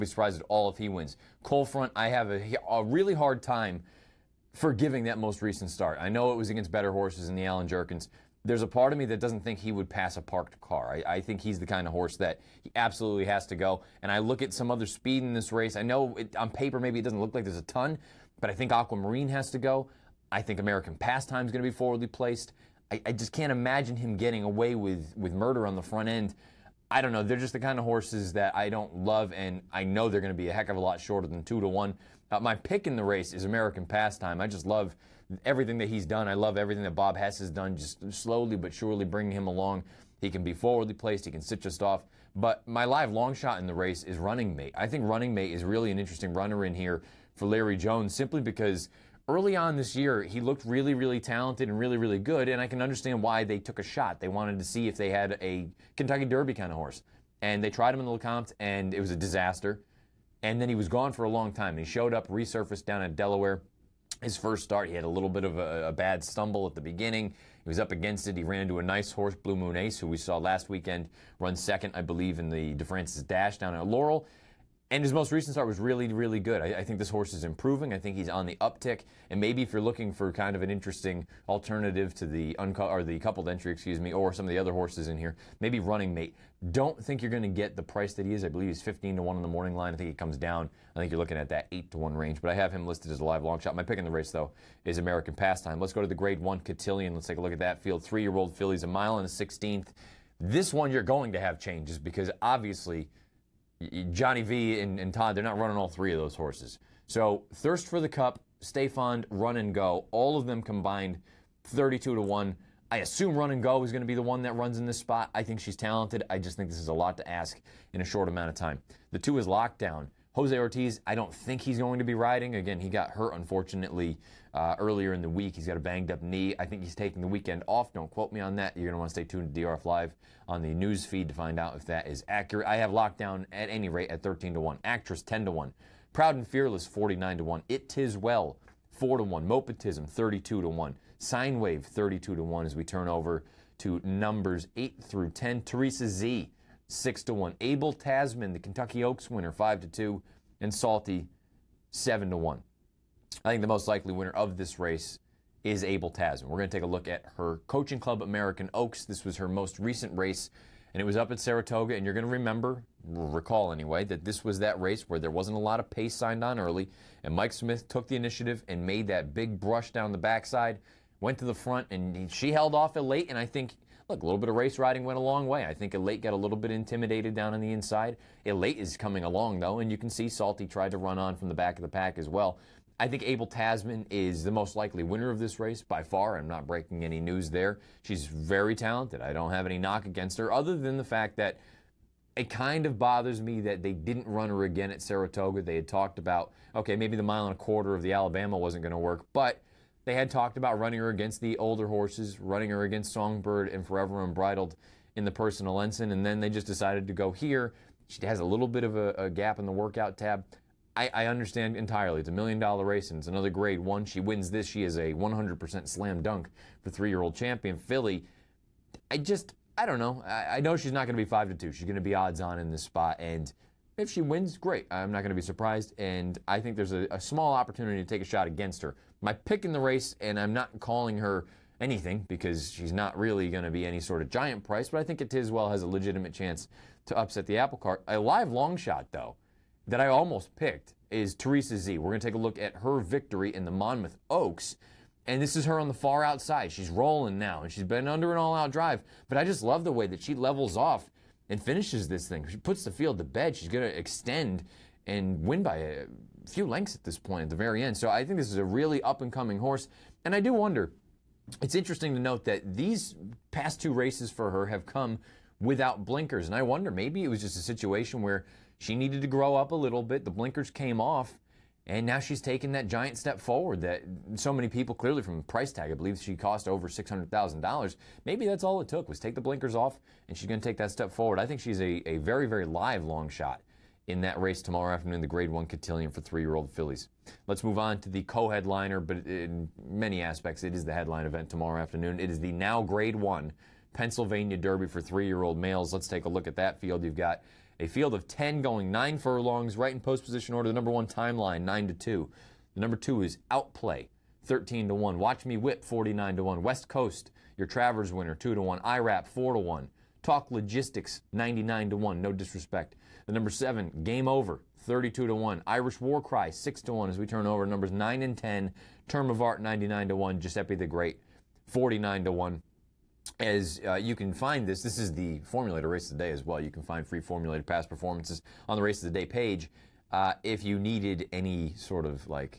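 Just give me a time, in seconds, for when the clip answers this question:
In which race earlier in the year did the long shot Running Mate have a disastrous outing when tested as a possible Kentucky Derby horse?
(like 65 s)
58 s.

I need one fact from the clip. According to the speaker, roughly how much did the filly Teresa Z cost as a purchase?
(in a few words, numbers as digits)
over $600,000.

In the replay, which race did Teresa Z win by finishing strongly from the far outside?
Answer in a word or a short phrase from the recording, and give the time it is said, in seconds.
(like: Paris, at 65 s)
Monmouth Oaks, at 243 s.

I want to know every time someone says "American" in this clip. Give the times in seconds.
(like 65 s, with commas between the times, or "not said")
20 s, 33 s, 94 s, 158 s.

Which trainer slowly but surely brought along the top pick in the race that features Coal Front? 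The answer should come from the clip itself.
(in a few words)
Bob Hess.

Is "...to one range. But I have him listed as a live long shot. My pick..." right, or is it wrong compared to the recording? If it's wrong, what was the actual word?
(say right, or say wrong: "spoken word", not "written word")
right.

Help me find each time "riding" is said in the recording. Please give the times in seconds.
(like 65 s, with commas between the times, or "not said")
122 s, 174 s.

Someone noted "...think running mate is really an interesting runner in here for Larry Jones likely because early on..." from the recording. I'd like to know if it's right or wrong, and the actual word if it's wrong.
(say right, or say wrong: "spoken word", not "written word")
wrong: "simply", not "likely".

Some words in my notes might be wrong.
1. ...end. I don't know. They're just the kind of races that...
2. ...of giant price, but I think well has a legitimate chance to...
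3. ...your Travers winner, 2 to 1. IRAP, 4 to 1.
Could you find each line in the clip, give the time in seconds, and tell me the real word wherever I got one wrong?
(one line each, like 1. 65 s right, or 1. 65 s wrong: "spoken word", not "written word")
1. 26 s wrong: "horses", not "races"
2. 234 s right
3. 307 s right.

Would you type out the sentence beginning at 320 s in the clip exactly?
Giuseppe the Great, 49 to 1.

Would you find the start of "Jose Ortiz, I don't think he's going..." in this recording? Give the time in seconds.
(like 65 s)
120 s.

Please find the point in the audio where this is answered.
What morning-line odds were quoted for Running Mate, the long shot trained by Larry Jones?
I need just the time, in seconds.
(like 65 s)
88 s.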